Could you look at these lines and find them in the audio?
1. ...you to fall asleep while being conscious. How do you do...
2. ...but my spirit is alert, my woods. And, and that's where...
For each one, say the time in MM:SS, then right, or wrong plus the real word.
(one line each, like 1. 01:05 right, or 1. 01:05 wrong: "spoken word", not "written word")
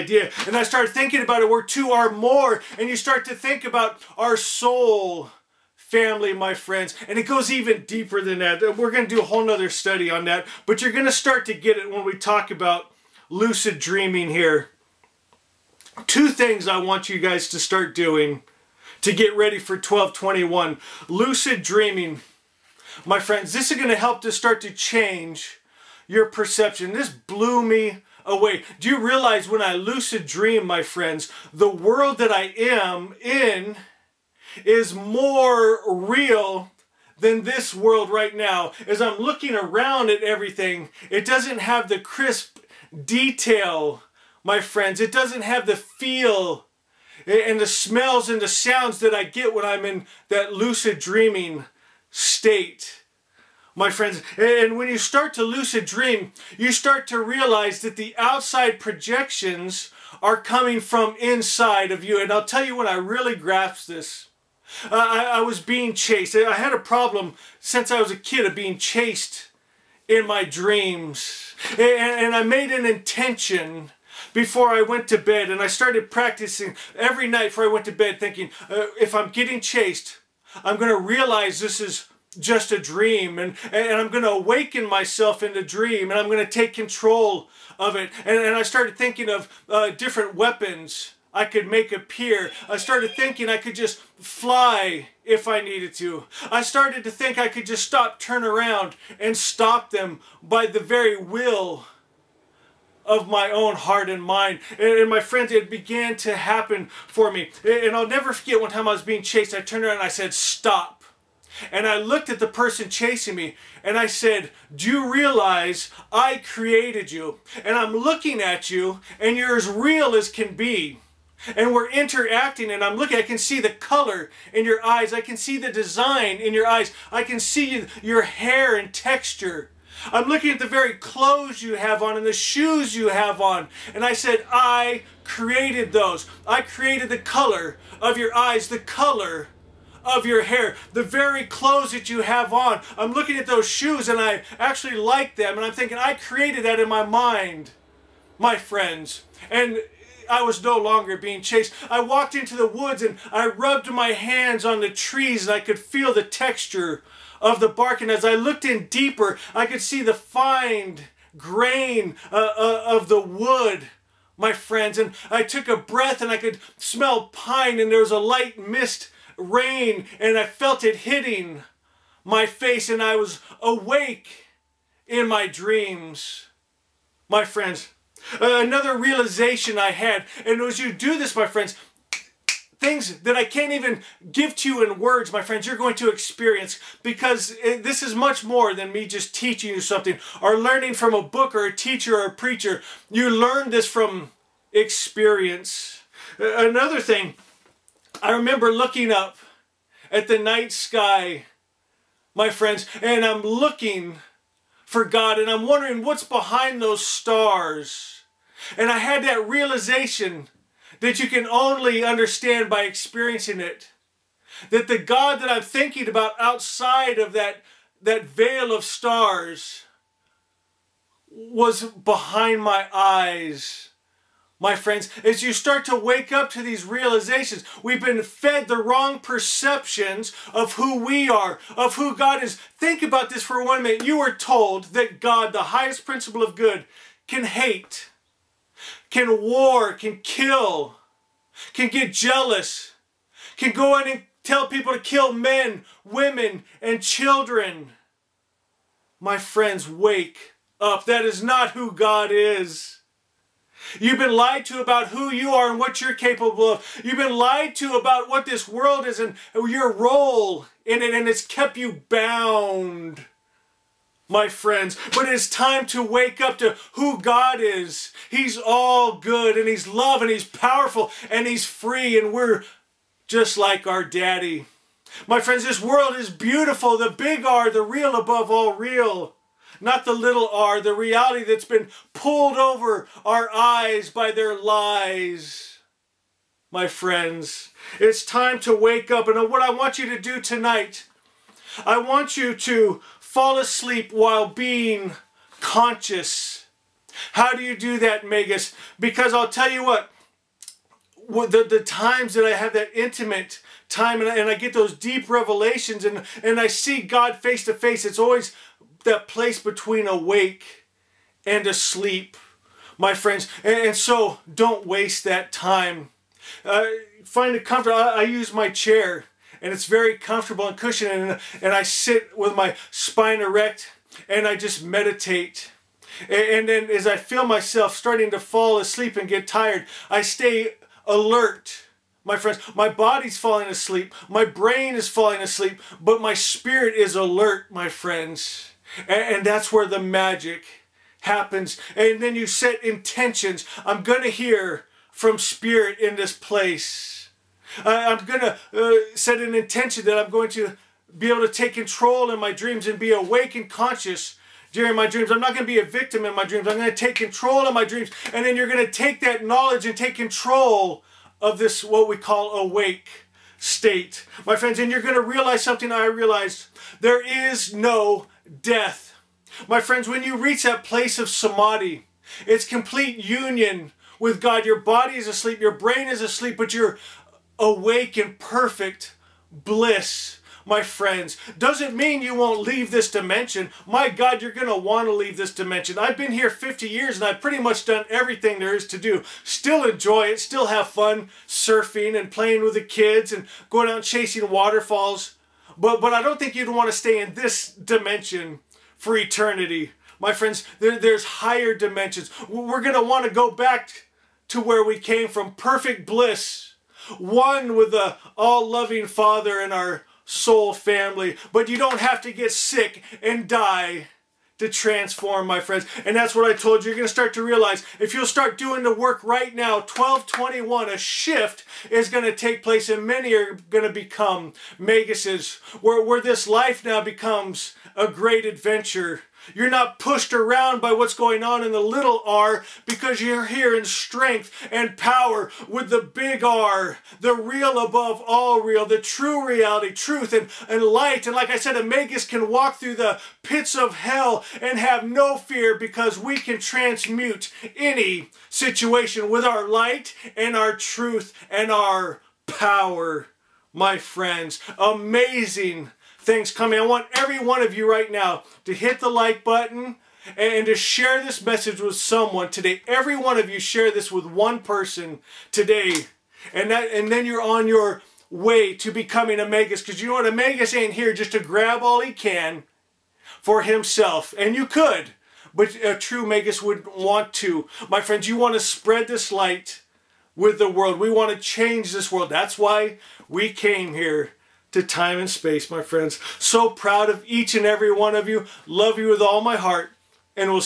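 1. 04:52 right
2. 05:35 wrong: "friends", not "woods".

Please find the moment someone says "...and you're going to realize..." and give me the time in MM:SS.
06:04.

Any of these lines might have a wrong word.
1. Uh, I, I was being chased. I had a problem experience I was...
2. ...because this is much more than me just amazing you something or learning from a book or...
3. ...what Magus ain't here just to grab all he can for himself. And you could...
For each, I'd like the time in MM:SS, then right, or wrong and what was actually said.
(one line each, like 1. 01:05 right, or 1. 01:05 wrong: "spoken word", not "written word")
1. 01:04 wrong: "since", not "experience"
2. 03:07 wrong: "teaching", not "amazing"
3. 07:50 right.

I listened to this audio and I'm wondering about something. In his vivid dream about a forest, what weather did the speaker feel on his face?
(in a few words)
Light mist rain.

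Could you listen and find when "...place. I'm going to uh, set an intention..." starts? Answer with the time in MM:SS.
05:46.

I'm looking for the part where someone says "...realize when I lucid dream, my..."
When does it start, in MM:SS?
00:29.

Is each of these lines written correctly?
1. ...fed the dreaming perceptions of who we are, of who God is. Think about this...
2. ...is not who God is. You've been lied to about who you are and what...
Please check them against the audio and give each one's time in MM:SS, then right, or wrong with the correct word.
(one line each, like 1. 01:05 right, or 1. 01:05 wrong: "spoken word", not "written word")
1. 03:48 wrong: "wrong", not "dreaming"
2. 04:11 right.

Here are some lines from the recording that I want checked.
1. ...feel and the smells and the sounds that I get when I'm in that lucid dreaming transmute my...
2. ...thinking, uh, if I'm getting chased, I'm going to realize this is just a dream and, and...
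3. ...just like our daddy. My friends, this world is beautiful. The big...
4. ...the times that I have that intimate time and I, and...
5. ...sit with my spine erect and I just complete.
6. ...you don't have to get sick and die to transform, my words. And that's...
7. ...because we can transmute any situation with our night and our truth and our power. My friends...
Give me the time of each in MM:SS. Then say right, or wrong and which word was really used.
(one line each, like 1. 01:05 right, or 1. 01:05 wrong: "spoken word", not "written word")
1. 00:45 wrong: "state", not "transmute"
2. 01:18 right
3. 04:33 right
4. 05:01 right
5. 05:21 wrong: "meditate", not "complete"
6. 06:51 wrong: "friends", not "words"
7. 07:25 wrong: "light", not "night".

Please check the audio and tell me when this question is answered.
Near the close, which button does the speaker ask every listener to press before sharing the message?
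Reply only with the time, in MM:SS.
07:39.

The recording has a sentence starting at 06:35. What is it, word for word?
But, but I don't think you'd want to stay in this dimension for eternity.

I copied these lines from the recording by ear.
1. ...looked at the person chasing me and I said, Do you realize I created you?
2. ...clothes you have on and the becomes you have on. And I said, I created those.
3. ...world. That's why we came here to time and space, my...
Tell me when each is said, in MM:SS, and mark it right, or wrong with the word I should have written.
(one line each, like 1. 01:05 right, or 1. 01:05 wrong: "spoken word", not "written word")
1. 01:51 right
2. 02:10 wrong: "shoes", not "becomes"
3. 08:02 right.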